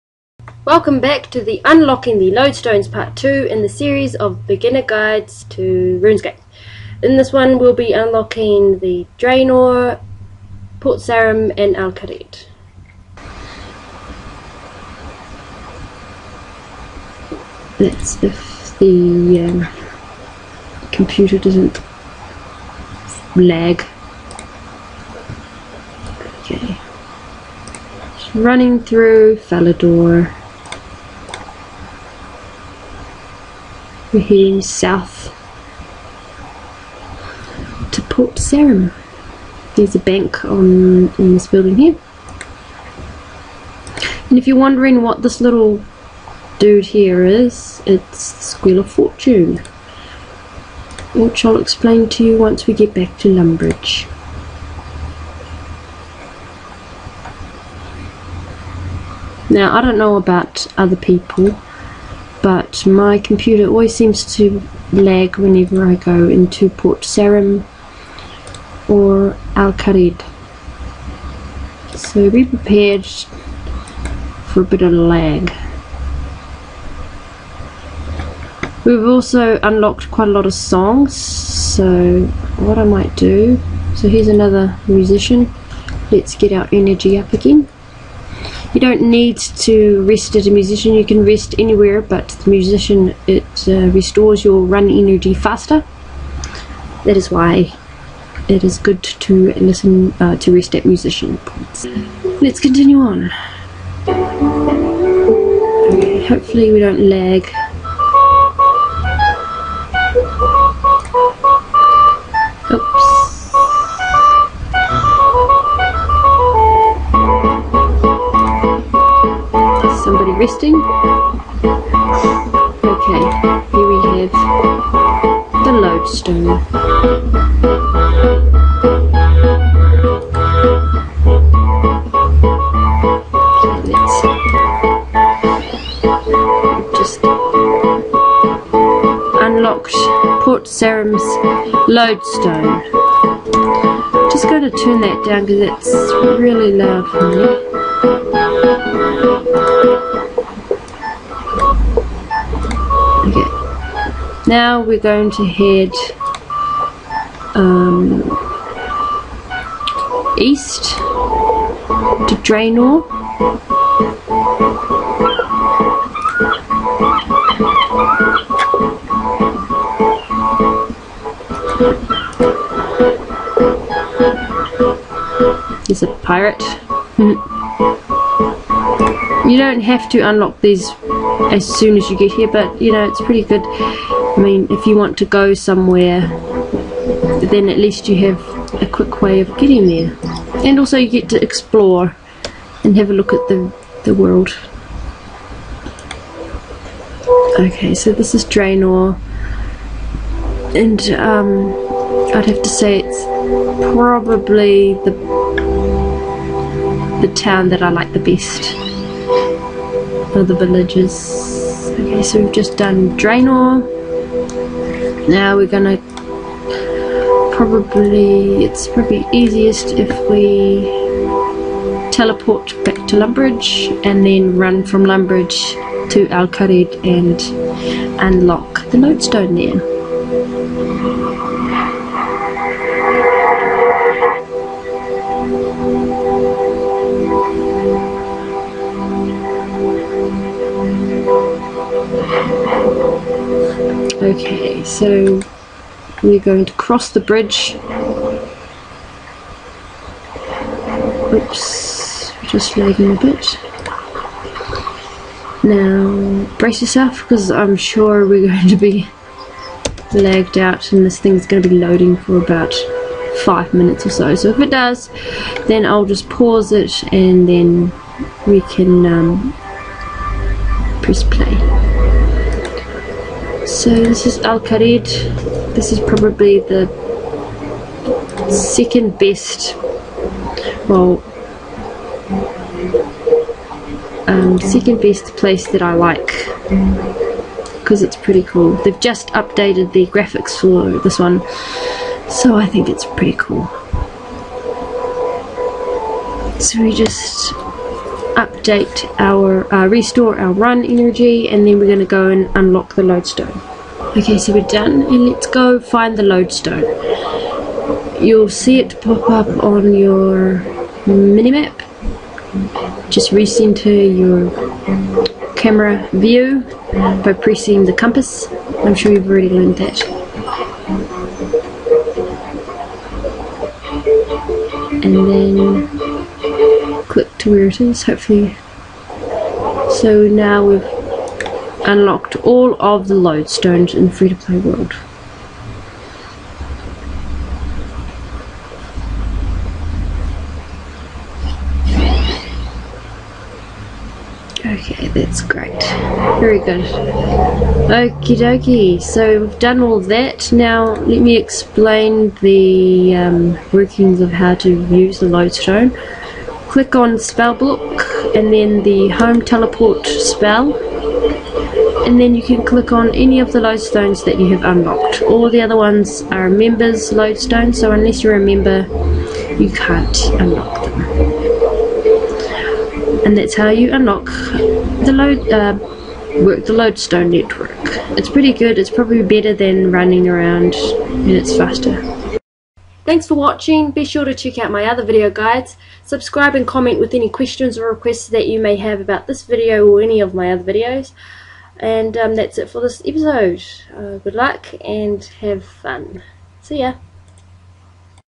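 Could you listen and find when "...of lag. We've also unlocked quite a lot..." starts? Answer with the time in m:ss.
1:14.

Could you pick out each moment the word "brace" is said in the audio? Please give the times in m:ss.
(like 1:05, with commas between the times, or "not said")
4:16.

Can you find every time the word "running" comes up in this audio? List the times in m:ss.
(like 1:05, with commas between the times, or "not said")
0:28, 6:19.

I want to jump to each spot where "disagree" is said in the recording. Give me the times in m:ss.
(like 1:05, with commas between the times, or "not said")
not said.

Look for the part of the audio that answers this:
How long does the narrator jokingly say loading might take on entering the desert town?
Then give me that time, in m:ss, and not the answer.
4:22.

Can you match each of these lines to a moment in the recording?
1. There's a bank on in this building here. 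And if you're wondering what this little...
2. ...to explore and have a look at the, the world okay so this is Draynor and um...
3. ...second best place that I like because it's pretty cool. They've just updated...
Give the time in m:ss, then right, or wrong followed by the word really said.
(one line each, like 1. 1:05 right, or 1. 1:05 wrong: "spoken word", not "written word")
1. 0:39 right
2. 3:11 right
3. 4:44 right.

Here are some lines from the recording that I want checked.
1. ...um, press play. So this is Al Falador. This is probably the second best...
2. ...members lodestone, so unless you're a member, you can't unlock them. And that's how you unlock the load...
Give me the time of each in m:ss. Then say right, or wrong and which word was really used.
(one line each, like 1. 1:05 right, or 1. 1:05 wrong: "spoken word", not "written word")
1. 4:29 wrong: "Kharid", not "Falador"
2. 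6:06 right.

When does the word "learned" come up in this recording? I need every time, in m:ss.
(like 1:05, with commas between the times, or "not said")
5:19.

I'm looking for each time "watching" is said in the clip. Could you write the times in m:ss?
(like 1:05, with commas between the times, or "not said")
6:23.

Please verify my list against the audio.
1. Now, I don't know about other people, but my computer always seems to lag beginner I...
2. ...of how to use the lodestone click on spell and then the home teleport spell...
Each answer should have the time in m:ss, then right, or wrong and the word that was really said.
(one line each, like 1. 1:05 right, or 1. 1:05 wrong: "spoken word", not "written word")
1. 0:59 wrong: "whenever", not "beginner"
2. 5:54 right.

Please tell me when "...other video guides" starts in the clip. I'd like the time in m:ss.
6:24.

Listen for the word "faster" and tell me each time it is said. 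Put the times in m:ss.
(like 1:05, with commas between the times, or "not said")
1:35, 6:21.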